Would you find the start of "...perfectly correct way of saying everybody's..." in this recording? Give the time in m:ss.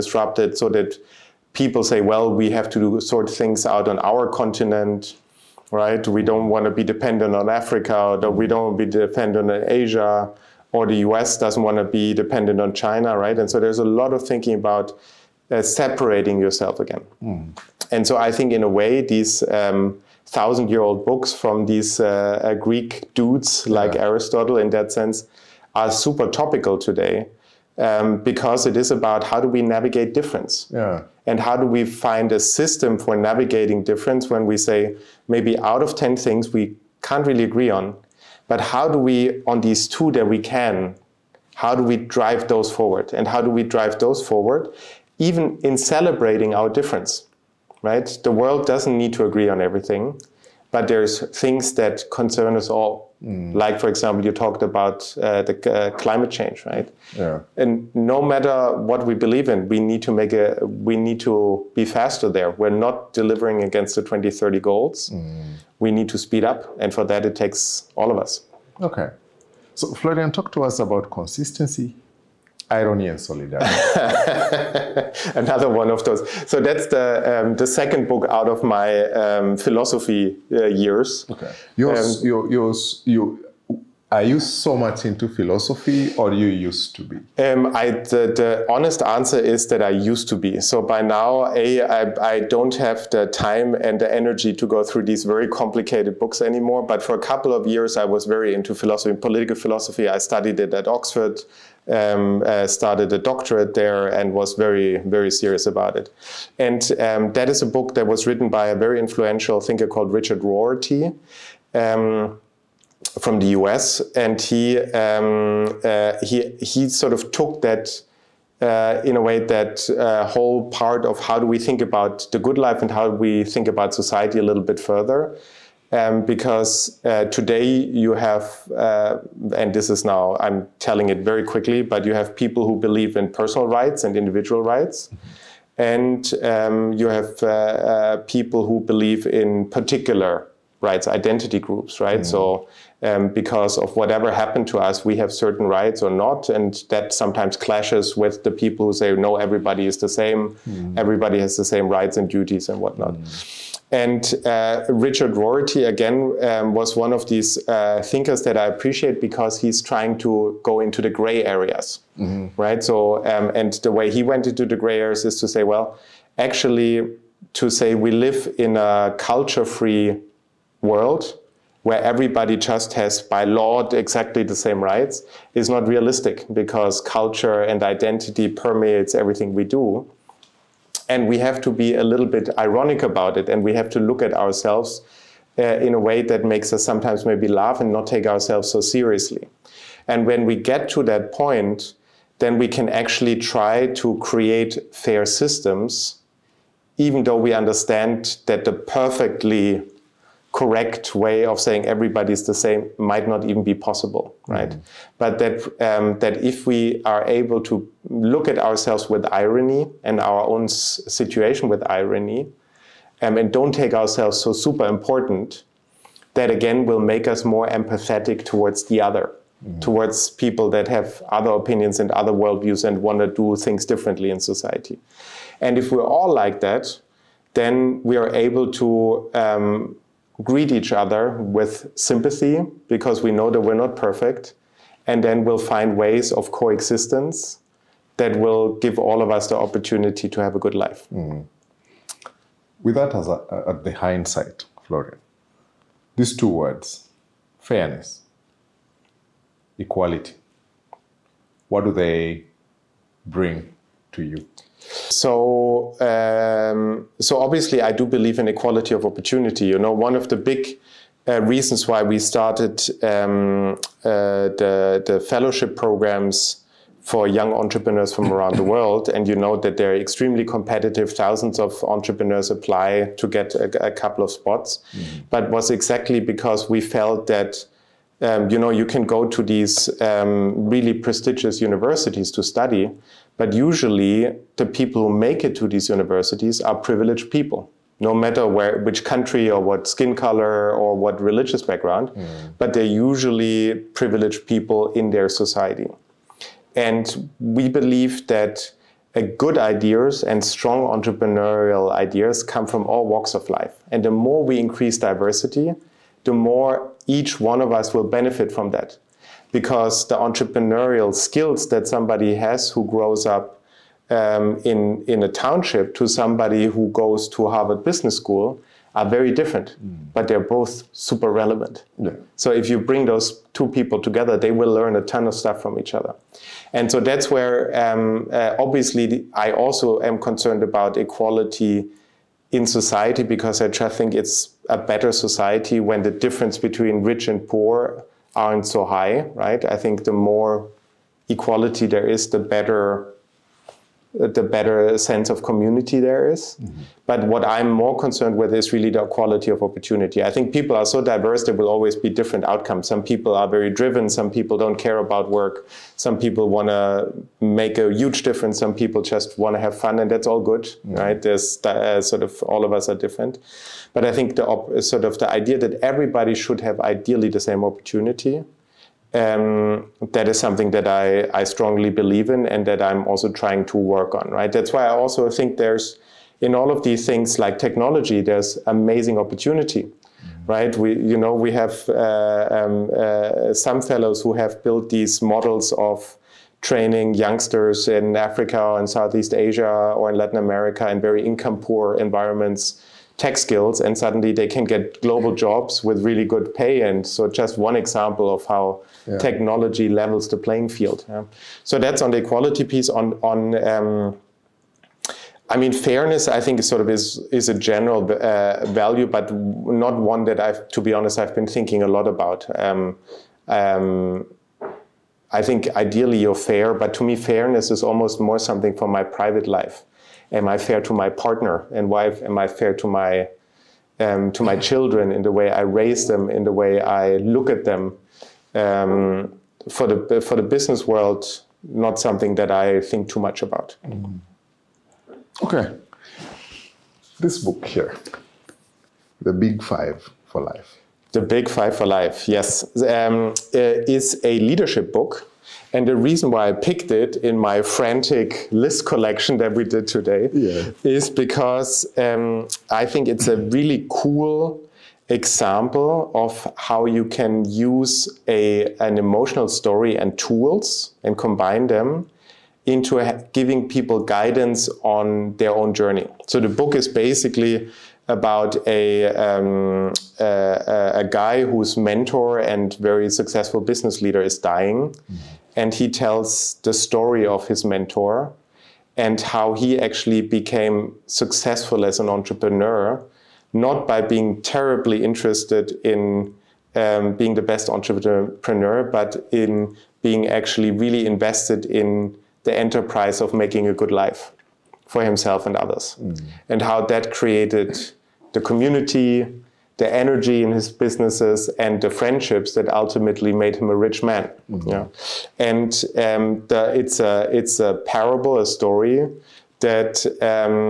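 3:18.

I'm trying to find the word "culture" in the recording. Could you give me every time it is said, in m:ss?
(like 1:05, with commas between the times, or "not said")
2:49, 2:56.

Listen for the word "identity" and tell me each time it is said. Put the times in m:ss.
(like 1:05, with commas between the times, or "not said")
2:21, 2:57.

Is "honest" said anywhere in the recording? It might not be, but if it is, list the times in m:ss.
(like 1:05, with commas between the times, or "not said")
1:28, 6:50.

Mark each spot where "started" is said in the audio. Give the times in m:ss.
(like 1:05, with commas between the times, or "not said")
1:42, 4:22.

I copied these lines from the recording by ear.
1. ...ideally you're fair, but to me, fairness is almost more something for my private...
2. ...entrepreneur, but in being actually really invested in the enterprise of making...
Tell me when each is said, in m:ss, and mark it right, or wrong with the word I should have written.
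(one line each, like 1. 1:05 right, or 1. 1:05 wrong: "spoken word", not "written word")
1. 6:55 right
2. 8:07 right.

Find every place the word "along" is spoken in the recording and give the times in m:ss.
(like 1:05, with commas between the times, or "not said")
not said.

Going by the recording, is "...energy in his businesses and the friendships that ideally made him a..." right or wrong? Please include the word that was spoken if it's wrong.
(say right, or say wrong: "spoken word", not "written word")
wrong: "ultimately", not "ideally".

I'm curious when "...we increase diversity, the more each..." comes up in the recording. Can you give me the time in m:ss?
5:04.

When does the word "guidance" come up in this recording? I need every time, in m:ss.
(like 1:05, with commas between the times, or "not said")
7:44.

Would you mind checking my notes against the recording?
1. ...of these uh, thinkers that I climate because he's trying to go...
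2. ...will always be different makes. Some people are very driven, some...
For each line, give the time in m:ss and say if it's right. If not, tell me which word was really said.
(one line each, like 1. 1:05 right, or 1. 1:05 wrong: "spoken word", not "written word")
1. 2:37 wrong: "appreciate", not "climate"
2. 5:51 wrong: "outcomes", not "makes".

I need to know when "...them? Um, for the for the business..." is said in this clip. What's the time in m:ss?
7:07.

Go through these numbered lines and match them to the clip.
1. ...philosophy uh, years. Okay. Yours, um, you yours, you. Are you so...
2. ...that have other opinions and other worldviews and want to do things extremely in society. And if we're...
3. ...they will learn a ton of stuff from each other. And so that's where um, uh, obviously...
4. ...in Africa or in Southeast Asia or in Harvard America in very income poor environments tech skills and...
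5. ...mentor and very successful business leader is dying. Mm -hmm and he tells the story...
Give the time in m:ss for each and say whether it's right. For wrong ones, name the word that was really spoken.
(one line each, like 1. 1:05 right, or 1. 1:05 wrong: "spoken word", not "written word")
1. 1:19 right
2. 3:40 wrong: "differently", not "extremely"
3. 5:24 right
4. 6:27 wrong: "Latin", not "Harvard"
5. 7:51 right.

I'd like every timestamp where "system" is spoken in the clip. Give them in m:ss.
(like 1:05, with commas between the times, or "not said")
0:32, 3:15.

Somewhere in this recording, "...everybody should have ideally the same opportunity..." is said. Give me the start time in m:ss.
6:05.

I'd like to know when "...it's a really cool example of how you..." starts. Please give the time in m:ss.
7:33.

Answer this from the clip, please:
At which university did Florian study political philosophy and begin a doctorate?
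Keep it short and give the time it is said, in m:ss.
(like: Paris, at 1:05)
Oxford, at 1:40.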